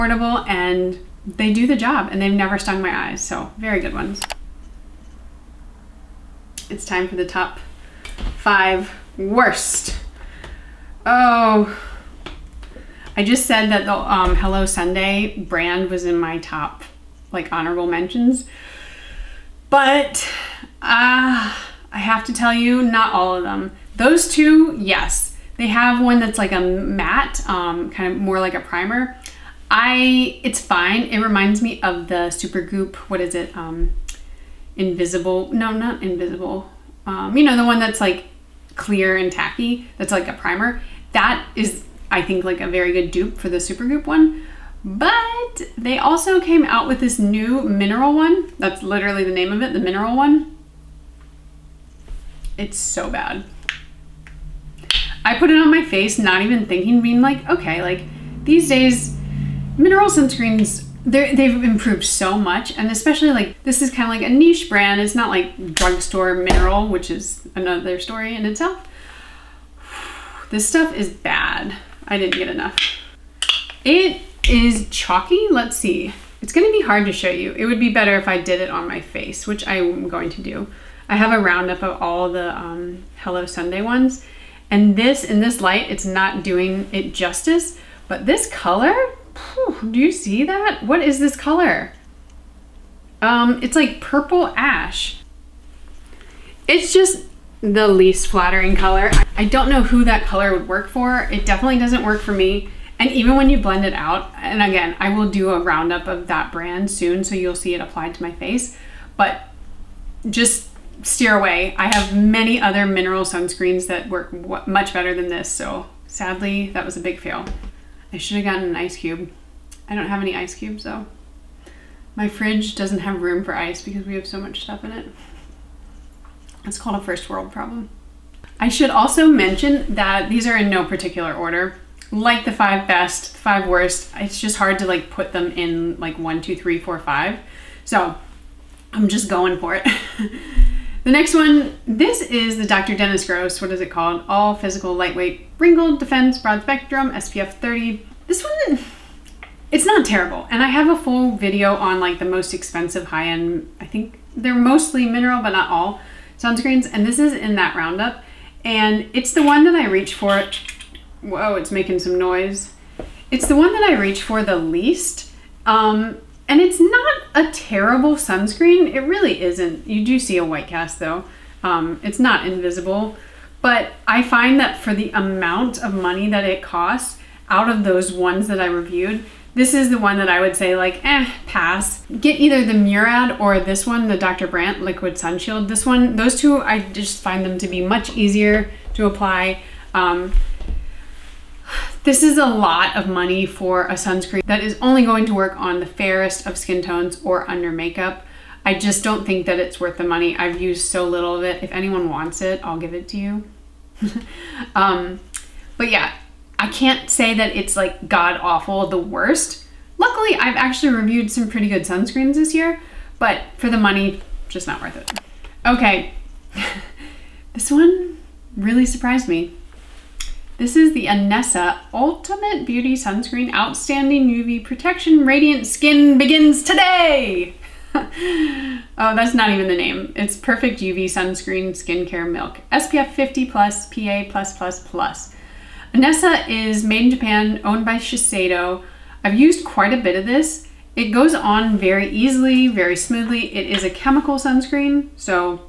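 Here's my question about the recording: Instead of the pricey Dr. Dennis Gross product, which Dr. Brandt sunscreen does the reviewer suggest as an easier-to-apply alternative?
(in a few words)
Liquid Sunshield.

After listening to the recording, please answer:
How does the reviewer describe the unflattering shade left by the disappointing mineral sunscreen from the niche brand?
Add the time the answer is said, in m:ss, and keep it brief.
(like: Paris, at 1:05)
purple ash, at 1:34.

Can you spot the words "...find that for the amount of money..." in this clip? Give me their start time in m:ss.
2:54.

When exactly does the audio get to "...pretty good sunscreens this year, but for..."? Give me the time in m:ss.
3:31.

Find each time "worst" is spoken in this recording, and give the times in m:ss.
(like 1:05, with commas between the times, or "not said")
0:09, 2:13, 3:28.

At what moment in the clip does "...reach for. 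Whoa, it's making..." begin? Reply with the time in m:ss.
2:39.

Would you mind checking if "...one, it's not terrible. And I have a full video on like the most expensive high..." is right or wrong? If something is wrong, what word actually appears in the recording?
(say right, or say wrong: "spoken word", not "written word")
right.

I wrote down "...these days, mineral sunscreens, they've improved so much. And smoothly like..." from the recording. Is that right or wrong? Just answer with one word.
wrong.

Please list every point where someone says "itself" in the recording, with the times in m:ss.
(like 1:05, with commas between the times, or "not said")
1:08.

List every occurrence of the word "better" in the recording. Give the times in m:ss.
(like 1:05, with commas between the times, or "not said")
1:17, 1:54.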